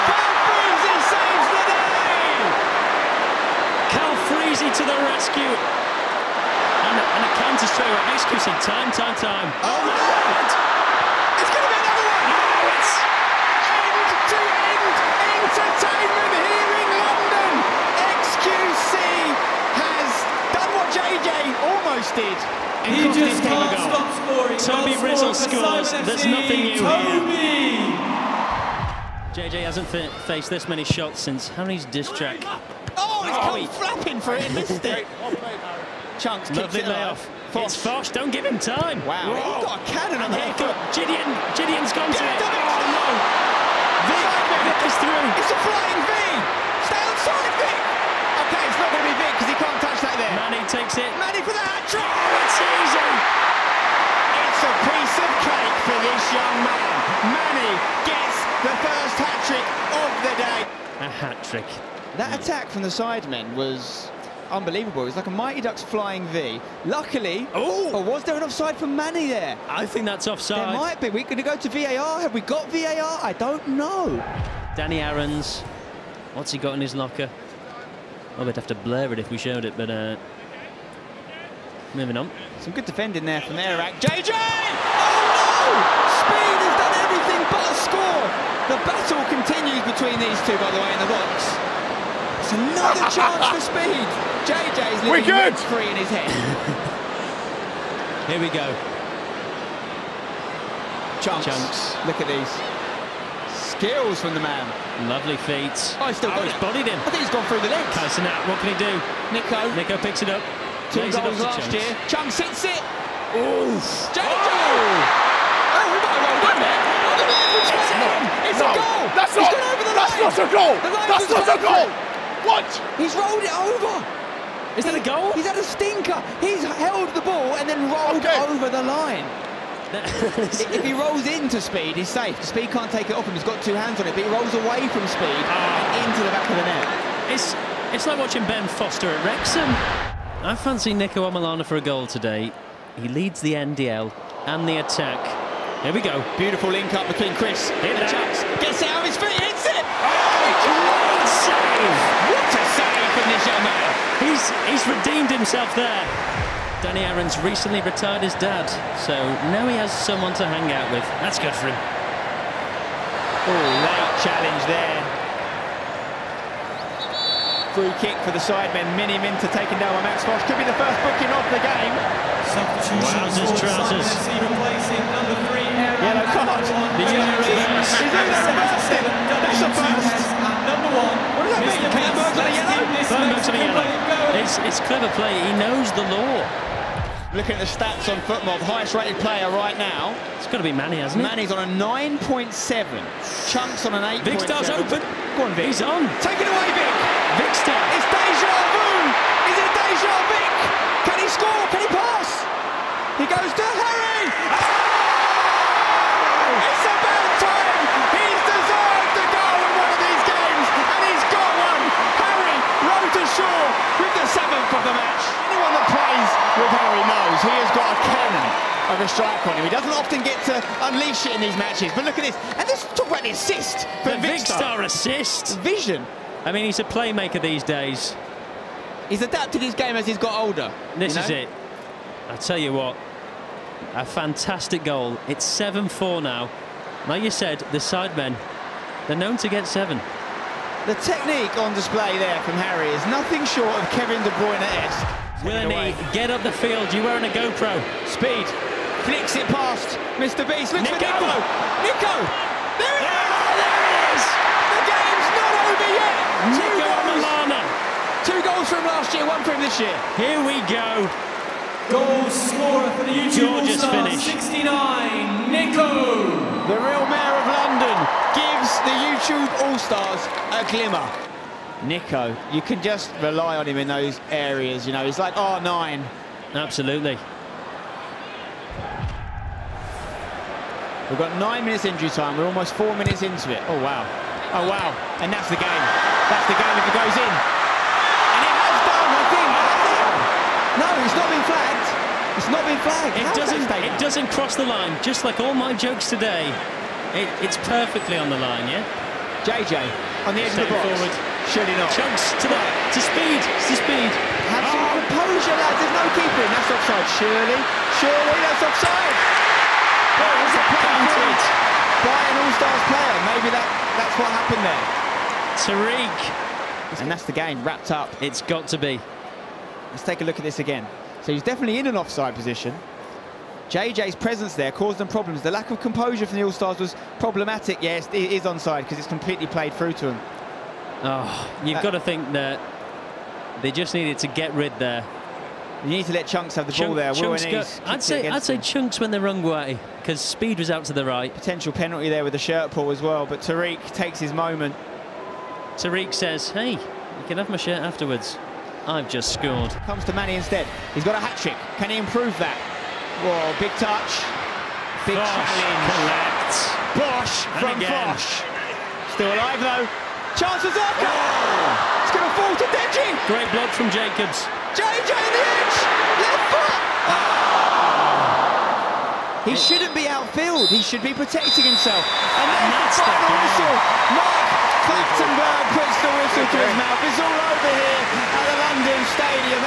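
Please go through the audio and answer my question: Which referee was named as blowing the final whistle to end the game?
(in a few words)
Mark Clattenburg.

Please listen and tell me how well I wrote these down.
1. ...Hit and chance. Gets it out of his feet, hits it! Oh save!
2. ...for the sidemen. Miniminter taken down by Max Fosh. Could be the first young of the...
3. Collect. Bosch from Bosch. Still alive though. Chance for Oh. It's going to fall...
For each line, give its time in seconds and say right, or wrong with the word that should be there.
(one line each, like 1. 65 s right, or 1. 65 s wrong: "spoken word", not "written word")
1. 147 s right
2. 168 s wrong: "booking", not "young"
3. 355 s right.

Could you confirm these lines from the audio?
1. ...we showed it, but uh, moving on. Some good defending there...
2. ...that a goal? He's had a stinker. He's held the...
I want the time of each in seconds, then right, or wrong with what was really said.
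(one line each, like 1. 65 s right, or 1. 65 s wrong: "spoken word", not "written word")
1. 79 s right
2. 124 s right.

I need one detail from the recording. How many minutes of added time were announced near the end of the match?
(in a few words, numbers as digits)
9.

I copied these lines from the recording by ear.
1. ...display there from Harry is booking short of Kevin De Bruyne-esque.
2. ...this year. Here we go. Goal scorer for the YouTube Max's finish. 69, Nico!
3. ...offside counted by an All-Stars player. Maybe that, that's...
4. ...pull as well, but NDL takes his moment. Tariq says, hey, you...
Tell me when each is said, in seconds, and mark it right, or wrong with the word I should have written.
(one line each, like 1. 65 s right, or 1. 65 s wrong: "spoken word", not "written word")
1. 241 s wrong: "nothing", not "booking"
2. 259 s wrong: "Georgia", not "Max"
3. 308 s right
4. 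342 s wrong: "Tariq", not "NDL".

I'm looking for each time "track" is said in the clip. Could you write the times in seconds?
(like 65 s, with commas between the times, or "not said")
32 s.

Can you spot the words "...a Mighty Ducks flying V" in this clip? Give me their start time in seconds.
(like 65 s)
65 s.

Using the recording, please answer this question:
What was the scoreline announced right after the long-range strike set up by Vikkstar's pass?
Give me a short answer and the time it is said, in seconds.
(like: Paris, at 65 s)
7-4, at 235 s.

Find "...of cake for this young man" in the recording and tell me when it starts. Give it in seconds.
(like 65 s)
55 s.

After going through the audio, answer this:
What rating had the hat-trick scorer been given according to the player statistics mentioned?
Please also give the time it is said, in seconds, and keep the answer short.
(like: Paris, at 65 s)
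9.7, at 191 s.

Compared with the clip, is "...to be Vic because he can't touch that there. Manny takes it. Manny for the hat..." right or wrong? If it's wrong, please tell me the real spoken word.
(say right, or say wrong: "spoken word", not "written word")
right.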